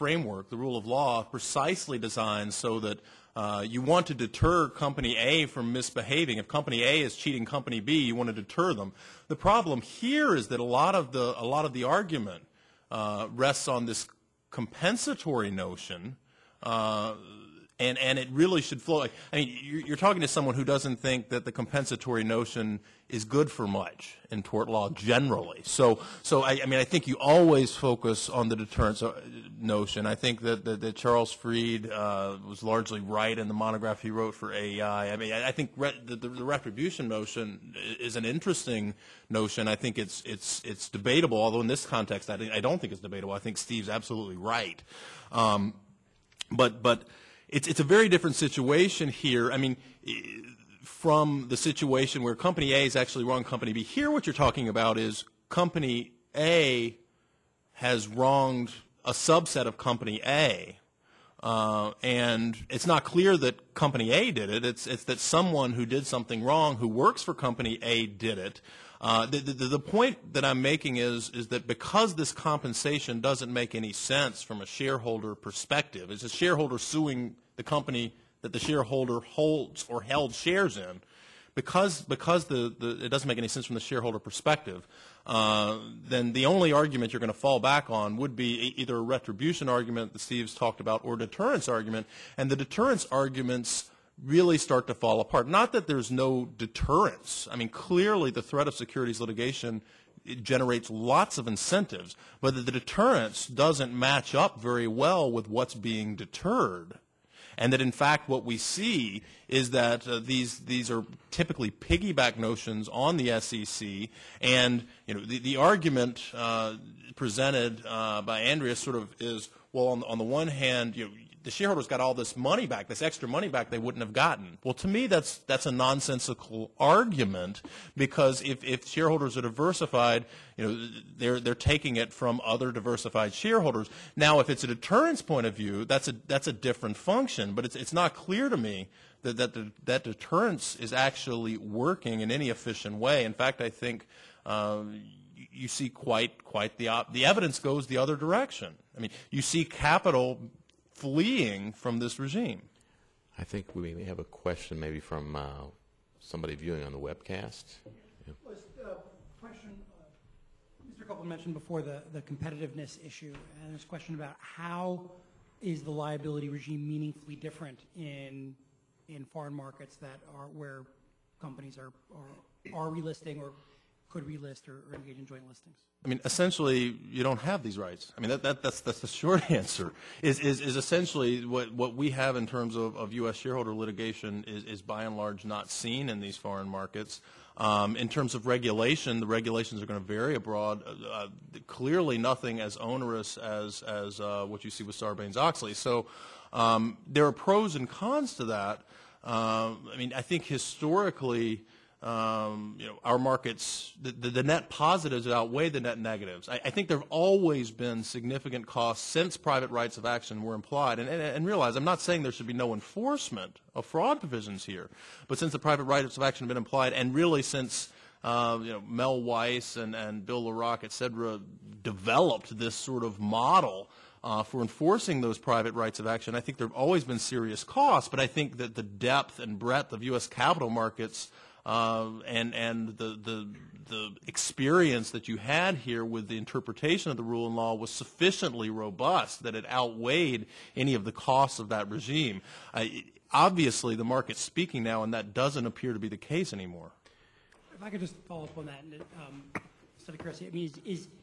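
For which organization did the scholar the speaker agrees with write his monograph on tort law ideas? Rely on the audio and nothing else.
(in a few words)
AEI.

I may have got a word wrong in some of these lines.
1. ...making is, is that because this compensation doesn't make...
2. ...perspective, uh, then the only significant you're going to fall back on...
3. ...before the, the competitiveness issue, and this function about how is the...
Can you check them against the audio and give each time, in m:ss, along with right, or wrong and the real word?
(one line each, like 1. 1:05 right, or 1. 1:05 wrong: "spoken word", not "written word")
1. 1:10 right
2. 1:24 wrong: "argument", not "significant"
3. 2:41 wrong: "question", not "function".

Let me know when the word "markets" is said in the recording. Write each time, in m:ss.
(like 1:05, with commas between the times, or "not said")
2:49, 3:06, 3:23, 3:50, 4:04.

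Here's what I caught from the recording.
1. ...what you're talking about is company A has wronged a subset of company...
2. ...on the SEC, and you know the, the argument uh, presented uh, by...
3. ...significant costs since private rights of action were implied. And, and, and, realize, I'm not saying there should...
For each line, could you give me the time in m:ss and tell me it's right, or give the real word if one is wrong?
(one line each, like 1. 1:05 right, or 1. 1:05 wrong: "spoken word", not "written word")
1. 0:54 right
2. 1:52 right
3. 3:28 right.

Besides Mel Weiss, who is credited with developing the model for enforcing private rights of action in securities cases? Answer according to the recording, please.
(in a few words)
Bill Lerach.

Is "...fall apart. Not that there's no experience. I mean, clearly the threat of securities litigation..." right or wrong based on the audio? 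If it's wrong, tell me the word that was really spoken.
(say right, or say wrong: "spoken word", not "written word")
wrong: "deterrence", not "experience".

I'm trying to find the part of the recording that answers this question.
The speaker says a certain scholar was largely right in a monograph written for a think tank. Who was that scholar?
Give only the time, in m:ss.
0:30.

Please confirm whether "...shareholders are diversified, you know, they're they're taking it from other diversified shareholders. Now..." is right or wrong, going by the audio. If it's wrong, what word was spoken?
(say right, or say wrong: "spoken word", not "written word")
right.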